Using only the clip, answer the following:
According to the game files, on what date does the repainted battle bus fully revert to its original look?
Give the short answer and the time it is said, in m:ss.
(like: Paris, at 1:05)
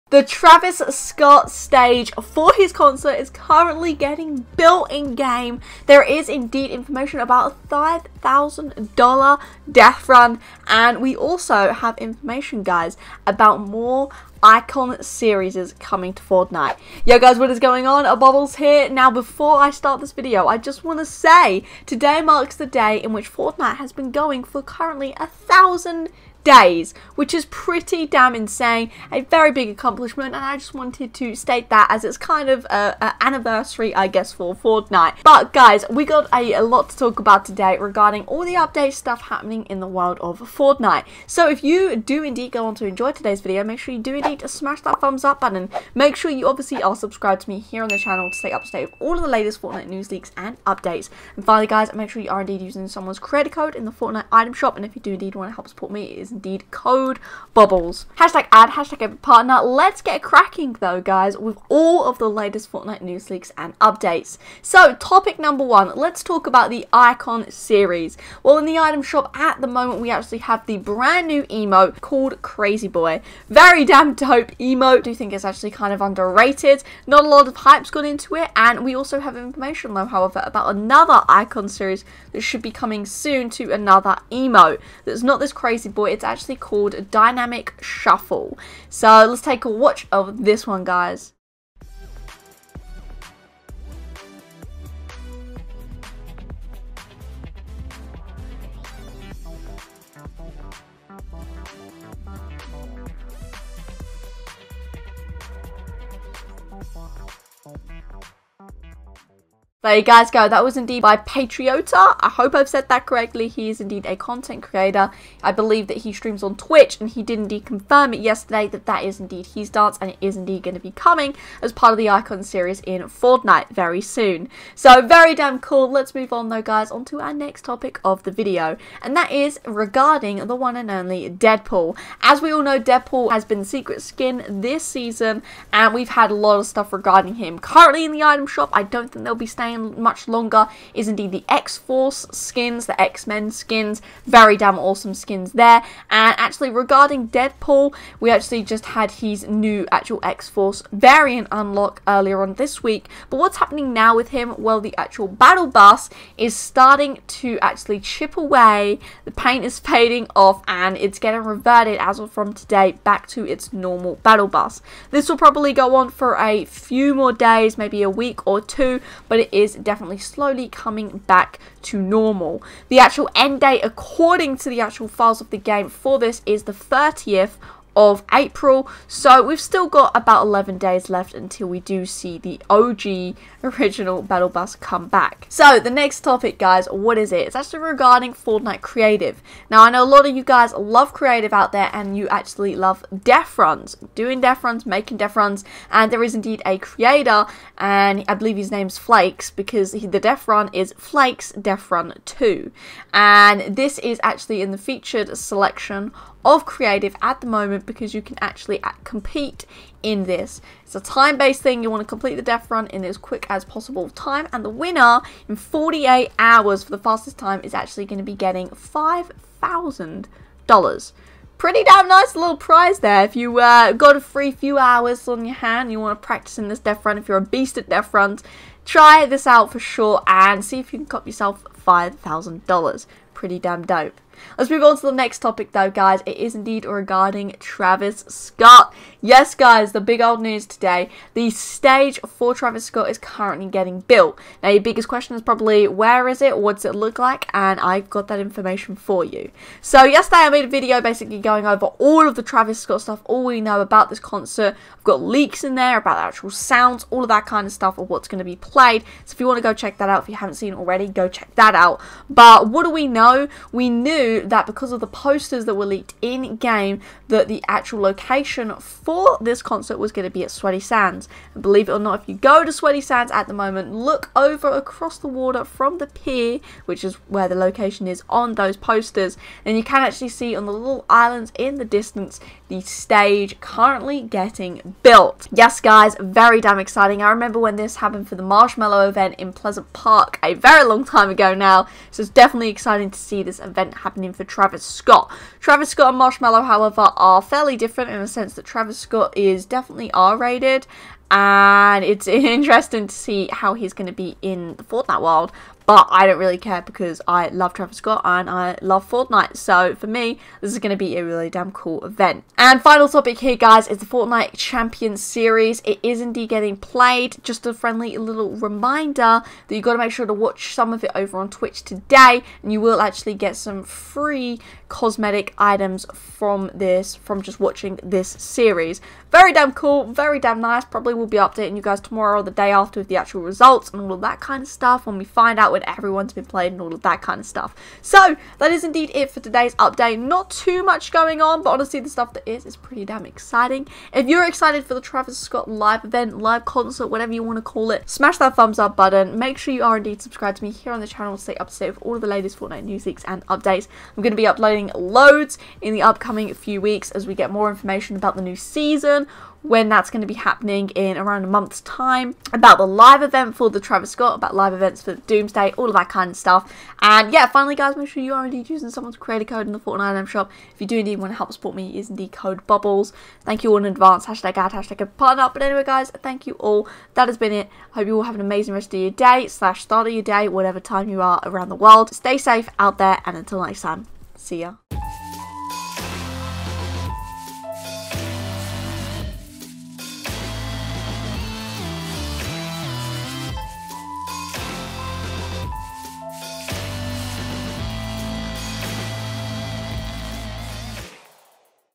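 30th of April, at 2:56.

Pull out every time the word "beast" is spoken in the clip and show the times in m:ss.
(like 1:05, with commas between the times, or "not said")
3:47.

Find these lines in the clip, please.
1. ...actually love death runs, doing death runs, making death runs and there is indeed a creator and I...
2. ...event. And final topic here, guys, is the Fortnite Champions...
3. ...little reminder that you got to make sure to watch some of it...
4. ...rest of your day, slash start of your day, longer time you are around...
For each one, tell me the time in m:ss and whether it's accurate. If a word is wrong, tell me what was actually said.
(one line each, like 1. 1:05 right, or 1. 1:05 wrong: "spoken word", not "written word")
1. 3:12 right
2. 5:12 right
3. 5:18 right
4. 6:18 wrong: "whatever", not "longer".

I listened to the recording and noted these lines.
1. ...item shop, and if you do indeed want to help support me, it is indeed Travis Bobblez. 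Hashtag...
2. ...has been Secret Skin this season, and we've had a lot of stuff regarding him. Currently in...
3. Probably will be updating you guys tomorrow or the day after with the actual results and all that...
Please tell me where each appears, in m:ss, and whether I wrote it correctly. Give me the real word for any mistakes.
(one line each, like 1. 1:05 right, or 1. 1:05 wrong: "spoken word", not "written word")
1. 0:54 wrong: "Code", not "Travis"
2. 2:13 right
3. 5:30 right.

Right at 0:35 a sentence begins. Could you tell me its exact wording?
But guys, we got a, a, lot to talk about today regarding all the update stuff happening in the world of Fortnite.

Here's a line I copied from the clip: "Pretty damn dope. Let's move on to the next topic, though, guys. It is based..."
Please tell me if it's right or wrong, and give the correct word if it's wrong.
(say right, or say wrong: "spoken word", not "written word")
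wrong: "indeed", not "based".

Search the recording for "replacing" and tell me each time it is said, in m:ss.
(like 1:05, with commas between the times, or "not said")
not said.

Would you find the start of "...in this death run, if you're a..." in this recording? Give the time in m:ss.
3:46.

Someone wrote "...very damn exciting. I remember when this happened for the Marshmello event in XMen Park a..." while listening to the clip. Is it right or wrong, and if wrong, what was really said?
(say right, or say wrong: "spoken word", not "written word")
wrong: "Pleasant", not "XMen".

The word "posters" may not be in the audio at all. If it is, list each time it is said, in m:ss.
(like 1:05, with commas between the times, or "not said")
4:25, 4:38.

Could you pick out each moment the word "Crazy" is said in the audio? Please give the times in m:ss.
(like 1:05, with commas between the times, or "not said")
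1:12, 1:25.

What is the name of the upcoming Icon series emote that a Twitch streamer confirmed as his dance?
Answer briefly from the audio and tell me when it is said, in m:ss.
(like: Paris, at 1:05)
Dynamic Shuffle, at 1:27.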